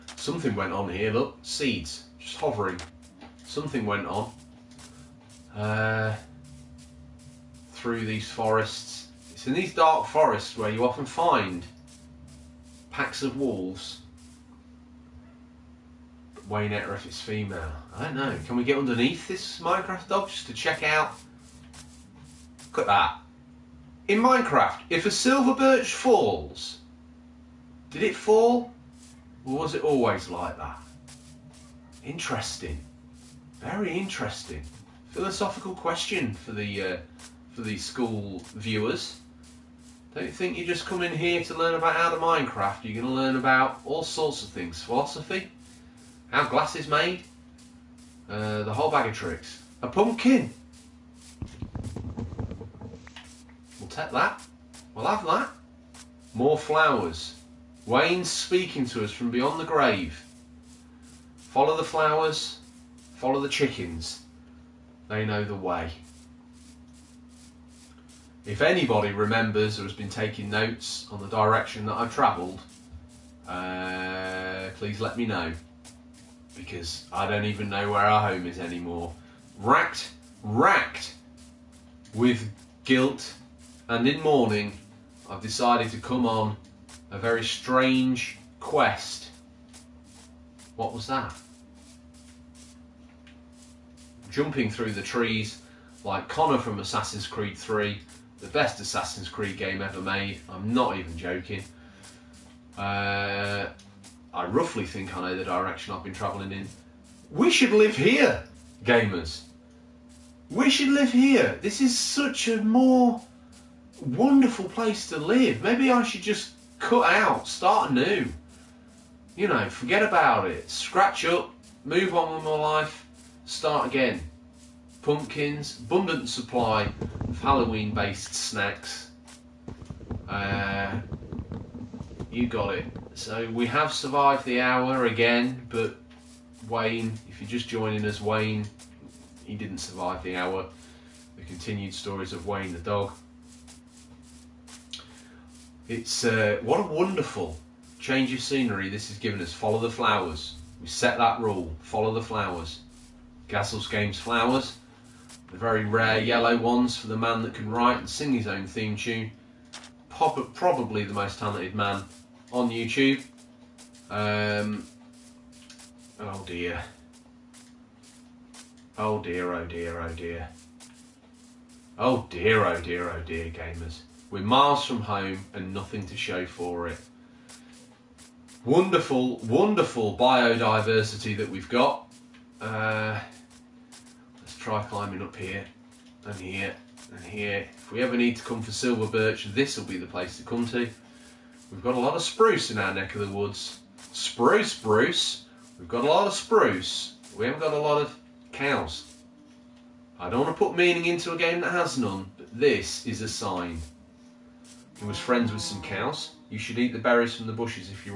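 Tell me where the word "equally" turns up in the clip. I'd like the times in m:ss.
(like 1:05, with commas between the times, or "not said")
not said.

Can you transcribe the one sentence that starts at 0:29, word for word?
Or was it always like that?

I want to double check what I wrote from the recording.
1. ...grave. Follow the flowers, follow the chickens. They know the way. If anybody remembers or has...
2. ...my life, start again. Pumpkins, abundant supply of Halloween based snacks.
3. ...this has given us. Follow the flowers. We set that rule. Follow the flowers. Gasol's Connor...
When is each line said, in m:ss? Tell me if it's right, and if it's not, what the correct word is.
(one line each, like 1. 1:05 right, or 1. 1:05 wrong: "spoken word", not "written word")
1. 0:59 right
2. 2:02 right
3. 2:28 wrong: "Games", not "Connor".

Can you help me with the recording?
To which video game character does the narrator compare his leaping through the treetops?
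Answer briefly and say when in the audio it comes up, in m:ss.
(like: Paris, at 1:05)
Connor, at 1:36.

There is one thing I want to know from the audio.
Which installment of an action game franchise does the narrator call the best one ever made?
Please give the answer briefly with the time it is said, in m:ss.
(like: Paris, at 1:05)
Assassin's Creed 3, at 1:36.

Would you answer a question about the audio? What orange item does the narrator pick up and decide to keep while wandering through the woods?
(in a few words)
A pumpkin.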